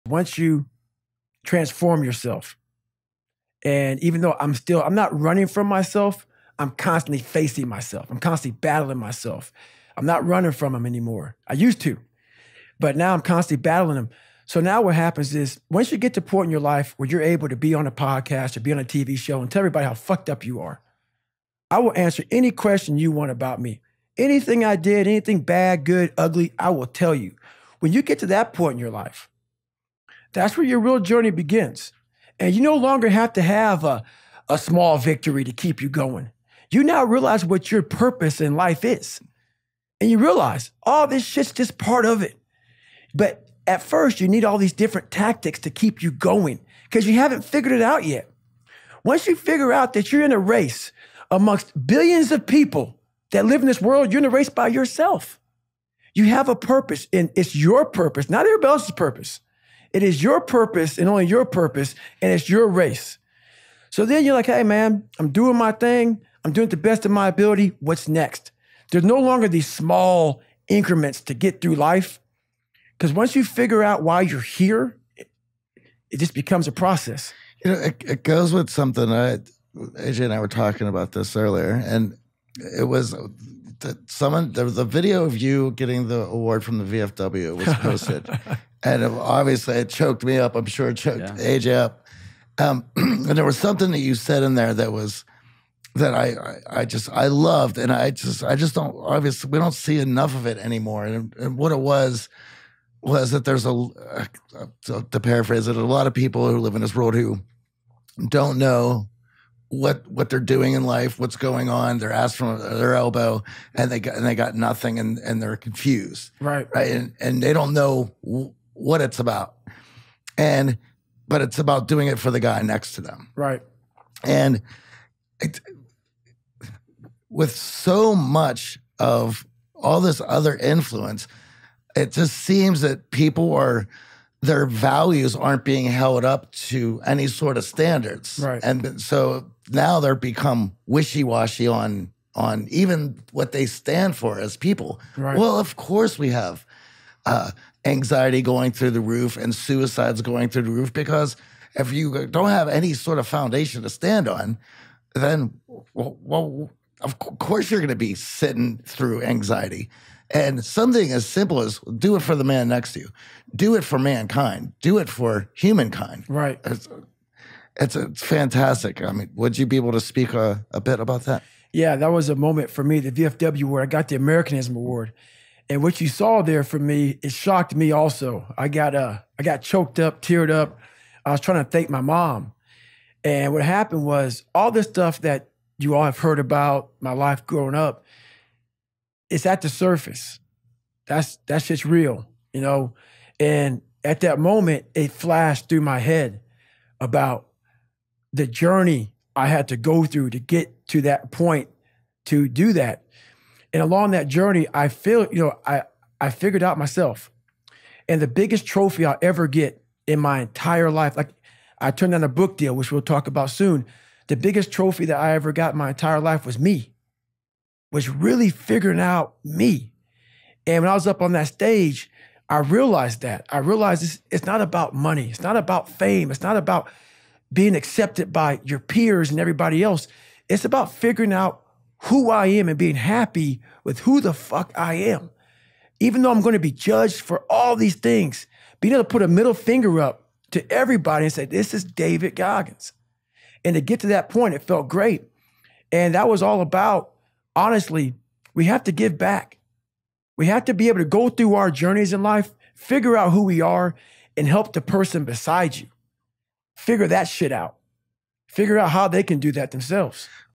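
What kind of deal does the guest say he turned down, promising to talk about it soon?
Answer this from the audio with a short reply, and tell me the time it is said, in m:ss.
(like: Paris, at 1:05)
A book deal, at 3:32.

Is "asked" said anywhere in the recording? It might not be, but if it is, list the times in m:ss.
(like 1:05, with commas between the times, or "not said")
1:52.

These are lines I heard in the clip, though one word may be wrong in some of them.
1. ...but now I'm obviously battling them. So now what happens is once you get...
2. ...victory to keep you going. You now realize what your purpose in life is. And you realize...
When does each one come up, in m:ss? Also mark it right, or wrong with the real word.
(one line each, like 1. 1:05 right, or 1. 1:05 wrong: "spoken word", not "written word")
1. 0:12 wrong: "constantly", not "obviously"
2. 0:34 right.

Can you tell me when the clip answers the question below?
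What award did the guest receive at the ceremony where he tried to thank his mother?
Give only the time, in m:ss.
2:54.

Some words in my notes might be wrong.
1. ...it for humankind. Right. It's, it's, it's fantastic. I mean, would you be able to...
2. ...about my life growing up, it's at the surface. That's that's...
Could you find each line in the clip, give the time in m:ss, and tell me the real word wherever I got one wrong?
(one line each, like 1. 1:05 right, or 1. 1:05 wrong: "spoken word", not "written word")
1. 2:44 right
2. 3:06 right.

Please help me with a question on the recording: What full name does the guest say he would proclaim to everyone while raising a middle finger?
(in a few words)
David Goggins.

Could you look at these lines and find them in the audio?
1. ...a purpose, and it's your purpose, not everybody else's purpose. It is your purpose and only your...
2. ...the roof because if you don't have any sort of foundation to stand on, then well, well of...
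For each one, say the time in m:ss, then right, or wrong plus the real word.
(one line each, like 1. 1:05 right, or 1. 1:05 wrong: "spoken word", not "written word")
1. 0:56 right
2. 2:30 right.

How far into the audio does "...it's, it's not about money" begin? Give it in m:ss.
3:44.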